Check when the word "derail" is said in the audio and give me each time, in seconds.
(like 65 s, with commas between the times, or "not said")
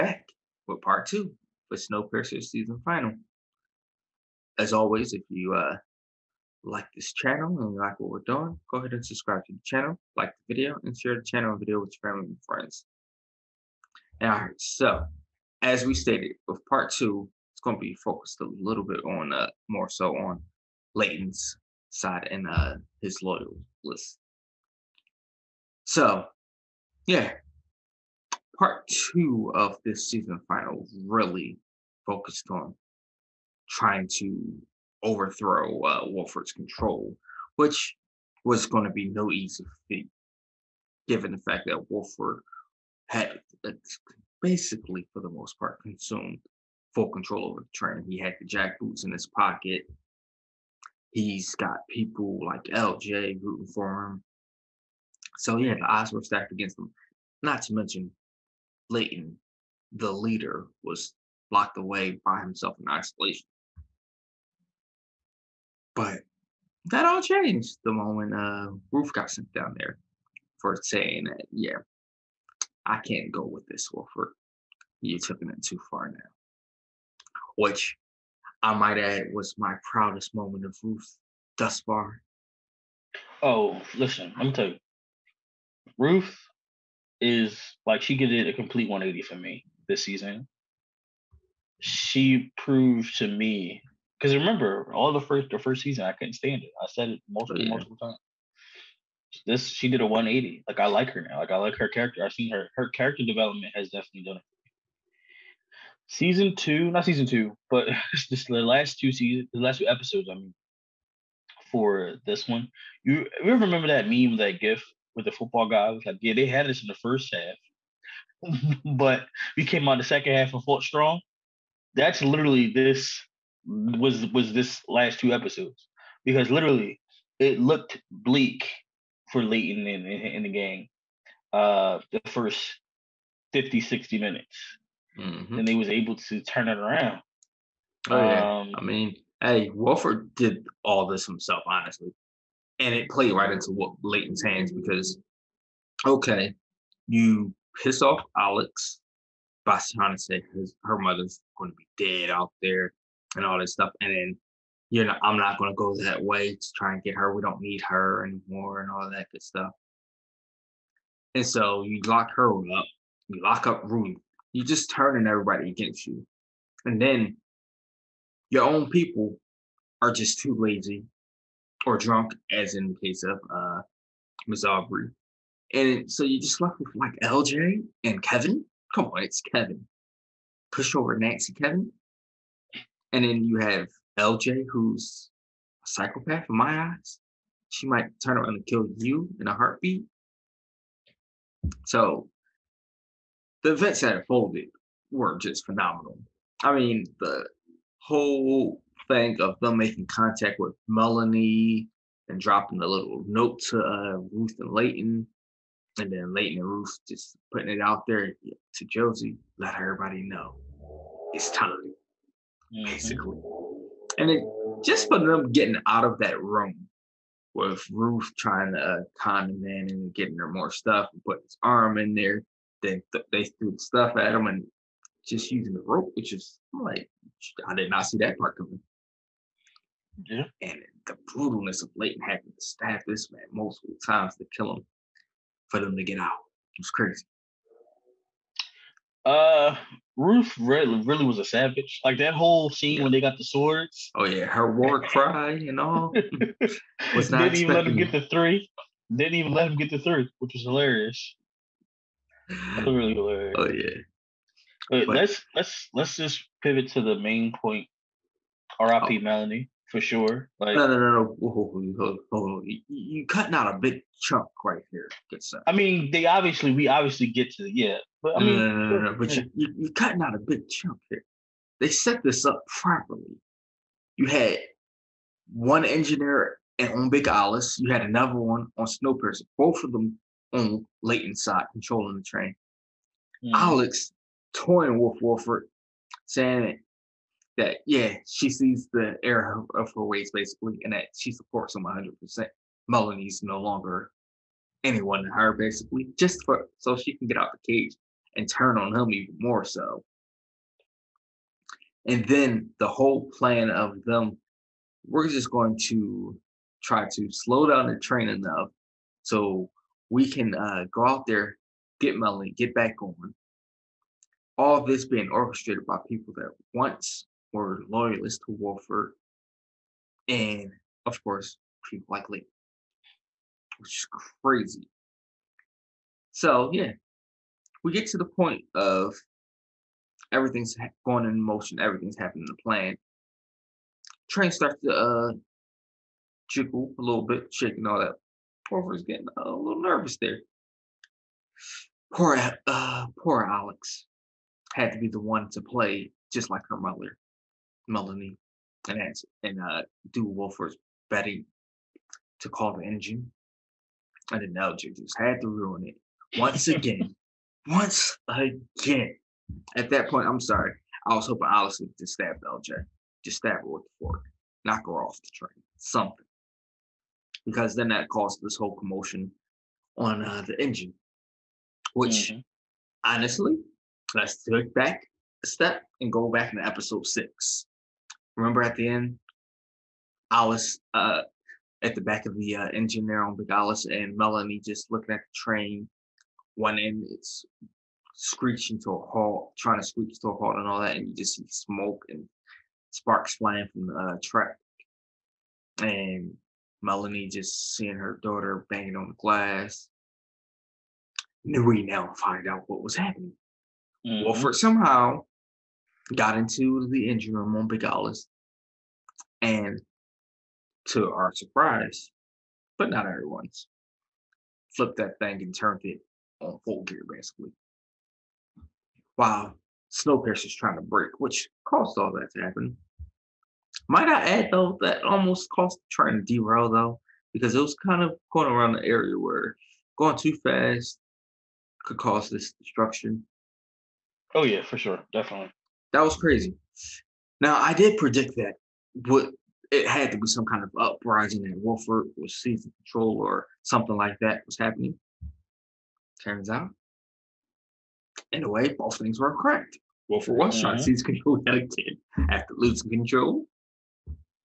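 426 s.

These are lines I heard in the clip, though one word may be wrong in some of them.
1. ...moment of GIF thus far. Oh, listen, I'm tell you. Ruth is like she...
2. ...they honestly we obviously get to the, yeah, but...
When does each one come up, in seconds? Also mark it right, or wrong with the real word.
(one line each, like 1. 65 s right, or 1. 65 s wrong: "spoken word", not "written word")
1. 80 s wrong: "Ruth", not "GIF"
2. 266 s wrong: "obviously", not "honestly".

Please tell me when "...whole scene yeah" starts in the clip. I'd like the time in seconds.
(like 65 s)
242 s.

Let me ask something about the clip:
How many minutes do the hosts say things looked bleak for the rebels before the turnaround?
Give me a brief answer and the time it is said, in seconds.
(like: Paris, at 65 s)
50, 60 minutes, at 132 s.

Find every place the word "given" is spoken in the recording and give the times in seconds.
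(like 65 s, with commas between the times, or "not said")
41 s.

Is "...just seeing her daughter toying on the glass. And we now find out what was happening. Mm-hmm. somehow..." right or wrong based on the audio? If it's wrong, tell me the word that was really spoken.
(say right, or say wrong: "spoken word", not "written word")
wrong: "banging", not "toying".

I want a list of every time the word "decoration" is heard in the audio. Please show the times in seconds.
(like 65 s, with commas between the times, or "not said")
not said.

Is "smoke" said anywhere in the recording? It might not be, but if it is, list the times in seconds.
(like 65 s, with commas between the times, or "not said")
391 s.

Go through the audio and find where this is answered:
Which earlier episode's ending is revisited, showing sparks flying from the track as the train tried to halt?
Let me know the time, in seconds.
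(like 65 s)
376 s.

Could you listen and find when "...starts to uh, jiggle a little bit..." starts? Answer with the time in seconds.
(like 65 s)
334 s.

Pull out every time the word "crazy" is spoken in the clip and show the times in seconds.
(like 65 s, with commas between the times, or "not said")
236 s, 324 s, 436 s.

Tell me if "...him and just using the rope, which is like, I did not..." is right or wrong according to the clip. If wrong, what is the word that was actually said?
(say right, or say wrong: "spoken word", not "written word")
right.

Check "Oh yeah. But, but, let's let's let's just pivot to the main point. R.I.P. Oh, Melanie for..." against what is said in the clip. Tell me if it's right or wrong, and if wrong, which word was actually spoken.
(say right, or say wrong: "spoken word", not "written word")
right.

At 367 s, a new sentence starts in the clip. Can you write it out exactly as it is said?
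Because then that caused this whole commotion on uh, the engine, which mm-hmm.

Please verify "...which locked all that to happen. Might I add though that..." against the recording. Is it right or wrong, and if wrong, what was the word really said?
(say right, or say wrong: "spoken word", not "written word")
wrong: "caused", not "locked".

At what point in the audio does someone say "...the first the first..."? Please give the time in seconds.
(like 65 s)
95 s.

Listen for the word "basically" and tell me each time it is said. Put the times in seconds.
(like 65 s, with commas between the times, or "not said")
44 s, 212 s, 290 s, 295 s, 417 s.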